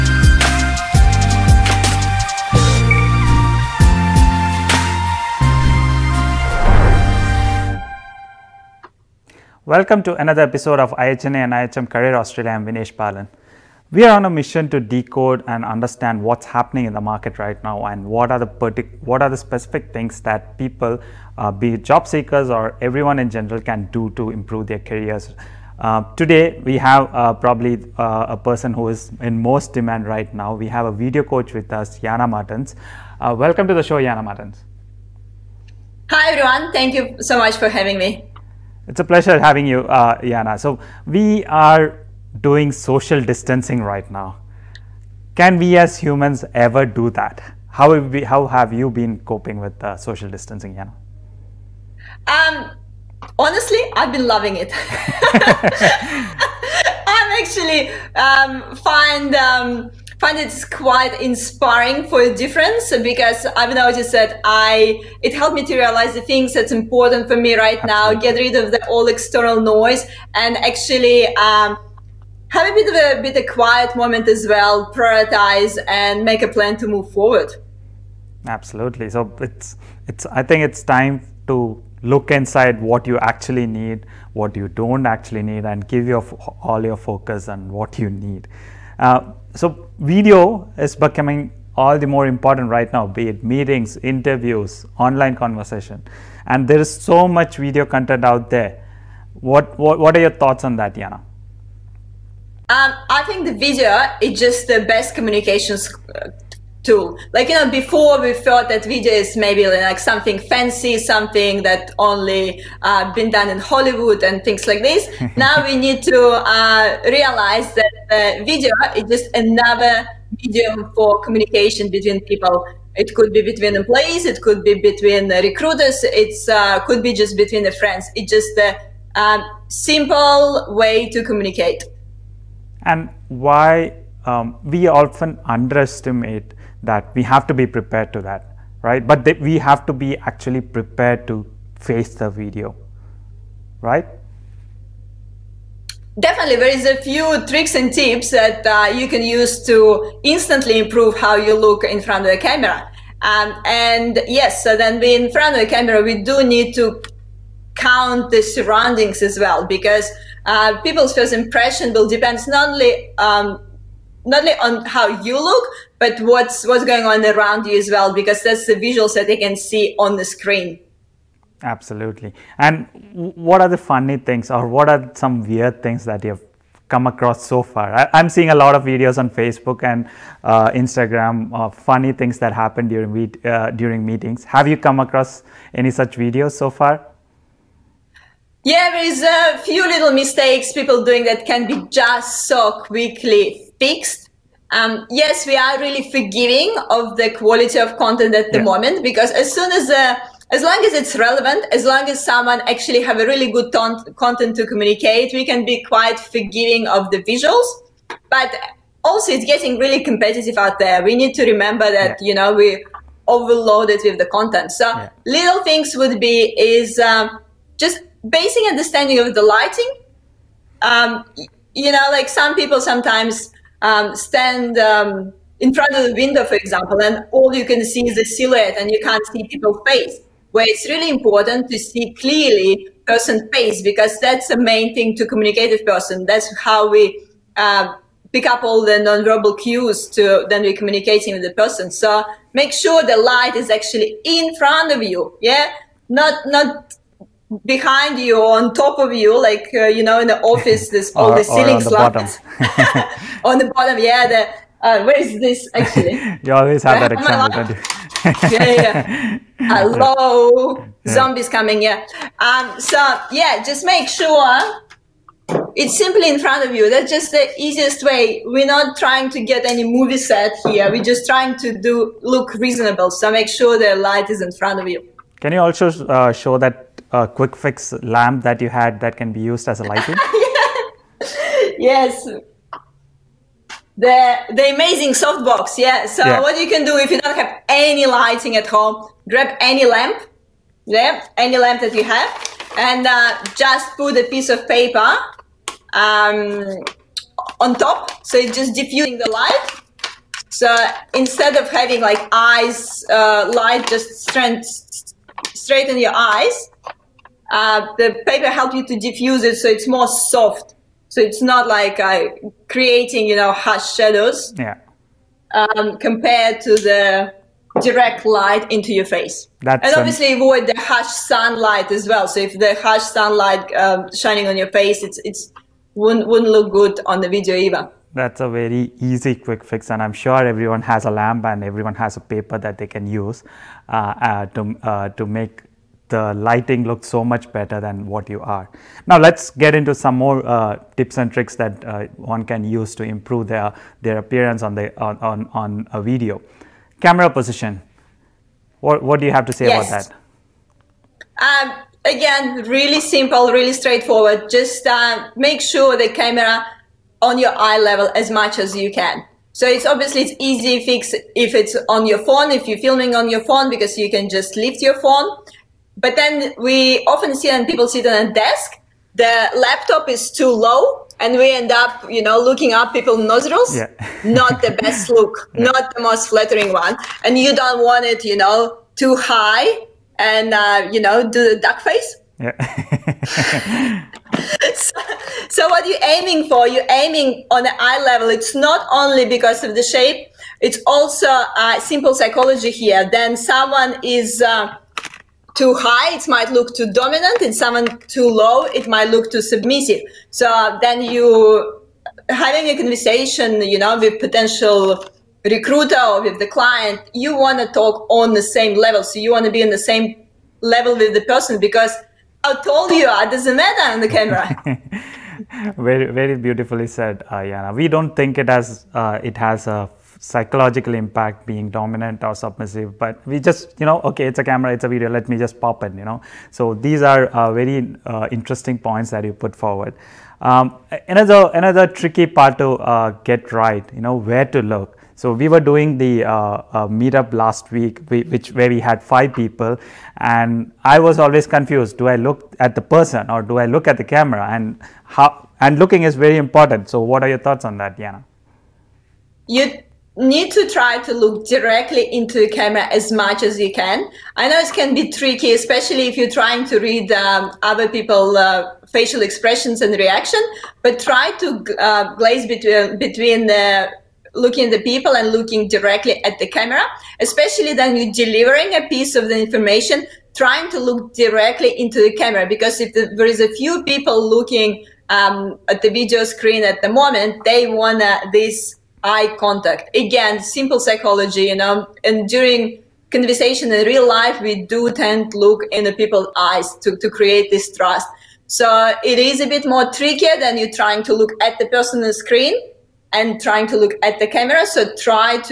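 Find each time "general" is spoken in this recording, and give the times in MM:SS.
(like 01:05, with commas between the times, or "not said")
00:23.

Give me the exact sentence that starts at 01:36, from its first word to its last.
And there is so much video content out there.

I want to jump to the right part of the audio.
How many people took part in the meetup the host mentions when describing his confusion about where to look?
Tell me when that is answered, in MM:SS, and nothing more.
07:19.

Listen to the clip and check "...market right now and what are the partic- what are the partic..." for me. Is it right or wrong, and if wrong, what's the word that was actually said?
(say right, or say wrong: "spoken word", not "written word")
wrong: "specific", not "partic".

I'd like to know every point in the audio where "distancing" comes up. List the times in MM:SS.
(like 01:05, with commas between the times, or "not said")
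00:43, 00:50.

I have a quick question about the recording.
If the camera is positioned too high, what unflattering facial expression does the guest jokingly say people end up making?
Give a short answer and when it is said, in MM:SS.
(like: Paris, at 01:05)
duck face, at 06:21.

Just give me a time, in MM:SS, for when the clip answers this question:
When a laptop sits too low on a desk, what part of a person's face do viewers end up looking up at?
06:13.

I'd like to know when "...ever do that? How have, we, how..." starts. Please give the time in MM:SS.
00:46.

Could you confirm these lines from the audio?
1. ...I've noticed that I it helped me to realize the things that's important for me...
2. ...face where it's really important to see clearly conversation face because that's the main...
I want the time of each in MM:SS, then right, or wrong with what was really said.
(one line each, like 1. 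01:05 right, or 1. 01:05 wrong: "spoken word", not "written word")
1. 01:03 right
2. 03:49 wrong: "person", not "conversation".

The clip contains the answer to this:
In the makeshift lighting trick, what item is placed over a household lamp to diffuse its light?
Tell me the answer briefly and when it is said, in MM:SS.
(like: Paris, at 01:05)
a piece of paper, at 04:54.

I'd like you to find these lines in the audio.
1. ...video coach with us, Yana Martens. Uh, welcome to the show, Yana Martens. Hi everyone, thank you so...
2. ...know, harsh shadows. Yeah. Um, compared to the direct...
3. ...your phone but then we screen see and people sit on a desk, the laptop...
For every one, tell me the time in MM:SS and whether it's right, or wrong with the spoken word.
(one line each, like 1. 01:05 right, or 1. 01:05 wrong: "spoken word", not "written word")
1. 00:30 right
2. 05:13 right
3. 06:04 wrong: "often", not "screen".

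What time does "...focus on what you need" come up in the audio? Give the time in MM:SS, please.
01:26.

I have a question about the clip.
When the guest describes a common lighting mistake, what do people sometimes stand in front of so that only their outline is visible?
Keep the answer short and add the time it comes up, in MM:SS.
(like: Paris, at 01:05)
the window, at 03:46.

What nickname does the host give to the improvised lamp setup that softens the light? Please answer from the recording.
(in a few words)
the amazing softbox.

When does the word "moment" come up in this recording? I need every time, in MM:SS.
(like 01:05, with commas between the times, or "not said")
01:13, 03:18, 07:56.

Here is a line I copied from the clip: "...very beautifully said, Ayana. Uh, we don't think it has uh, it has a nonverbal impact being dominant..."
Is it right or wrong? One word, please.
wrong.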